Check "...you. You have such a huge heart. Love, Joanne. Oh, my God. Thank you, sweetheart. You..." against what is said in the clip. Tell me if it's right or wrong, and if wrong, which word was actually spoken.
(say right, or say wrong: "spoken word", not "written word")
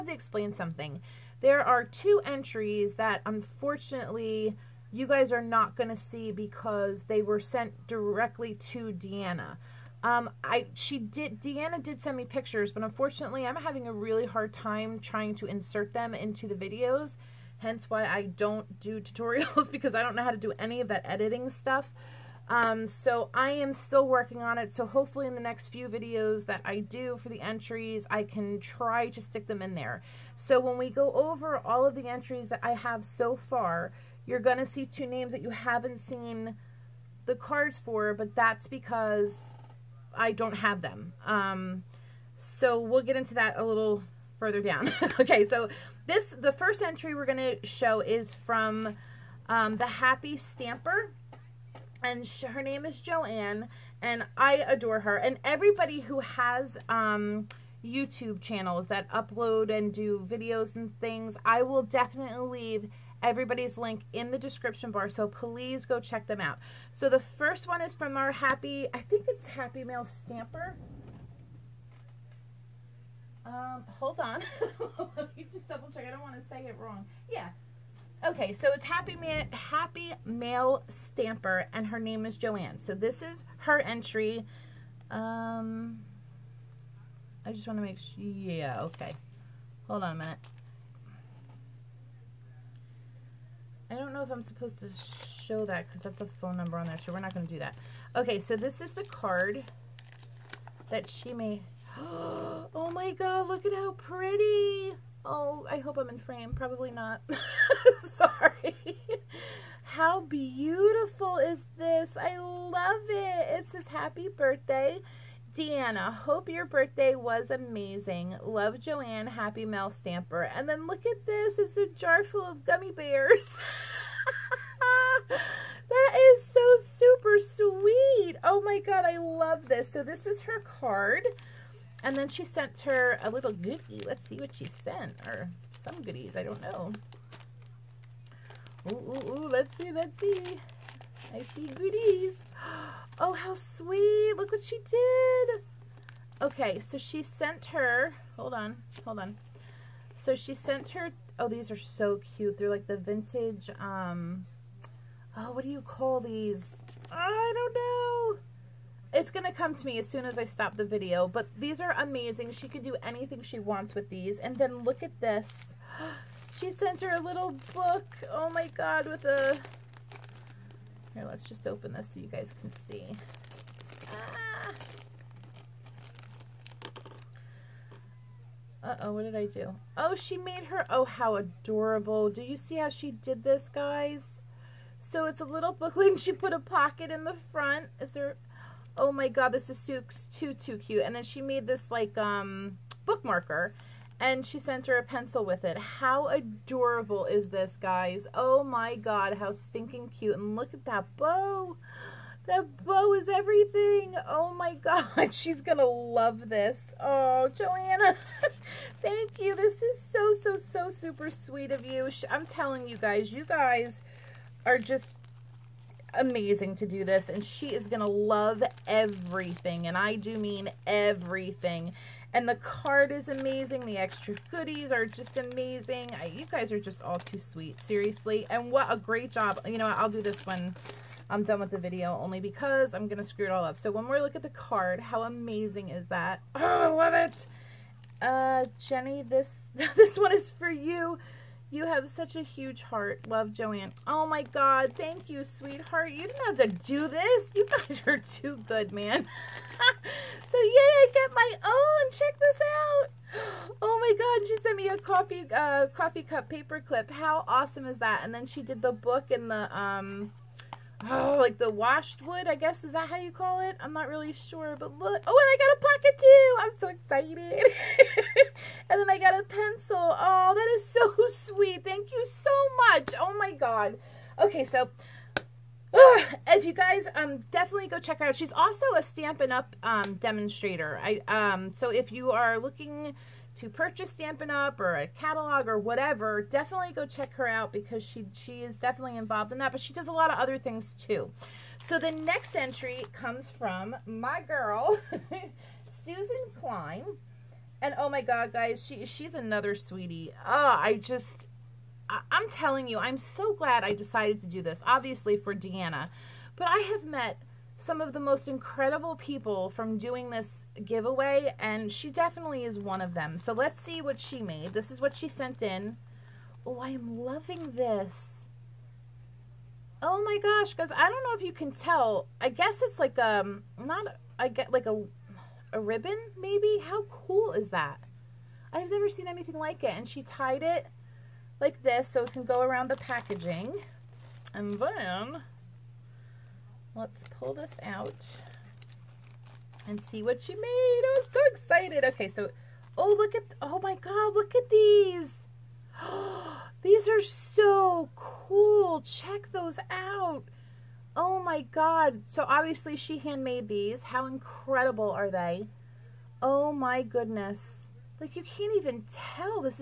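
right.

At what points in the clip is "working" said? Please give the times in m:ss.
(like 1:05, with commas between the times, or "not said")
0:24.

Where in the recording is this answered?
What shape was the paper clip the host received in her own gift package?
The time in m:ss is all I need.
4:15.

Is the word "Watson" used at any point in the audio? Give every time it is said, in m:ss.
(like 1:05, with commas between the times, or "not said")
not said.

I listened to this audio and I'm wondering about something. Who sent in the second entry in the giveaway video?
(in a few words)
Susan Klein.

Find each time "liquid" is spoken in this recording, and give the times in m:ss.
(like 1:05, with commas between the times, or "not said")
not said.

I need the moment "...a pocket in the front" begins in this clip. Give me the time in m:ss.
3:06.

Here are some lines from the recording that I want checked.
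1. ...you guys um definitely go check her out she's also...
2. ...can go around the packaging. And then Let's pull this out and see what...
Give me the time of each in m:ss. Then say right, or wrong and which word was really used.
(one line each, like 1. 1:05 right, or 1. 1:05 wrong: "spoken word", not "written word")
1. 4:36 right
2. 5:32 right.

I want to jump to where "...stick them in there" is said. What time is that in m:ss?
0:29.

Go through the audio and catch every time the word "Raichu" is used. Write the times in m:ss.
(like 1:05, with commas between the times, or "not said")
not said.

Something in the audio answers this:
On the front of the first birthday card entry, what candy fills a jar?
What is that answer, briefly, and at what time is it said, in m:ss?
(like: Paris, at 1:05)
Gummy bears, at 2:02.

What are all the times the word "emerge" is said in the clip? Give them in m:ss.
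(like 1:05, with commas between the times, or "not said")
not said.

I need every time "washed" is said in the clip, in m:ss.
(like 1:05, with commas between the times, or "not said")
4:21.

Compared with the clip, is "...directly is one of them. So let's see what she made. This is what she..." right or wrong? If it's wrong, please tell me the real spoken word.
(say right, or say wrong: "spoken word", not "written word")
wrong: "definitely", not "directly".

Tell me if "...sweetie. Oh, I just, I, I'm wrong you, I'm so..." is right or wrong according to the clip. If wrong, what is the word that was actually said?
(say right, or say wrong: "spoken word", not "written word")
wrong: "telling", not "wrong".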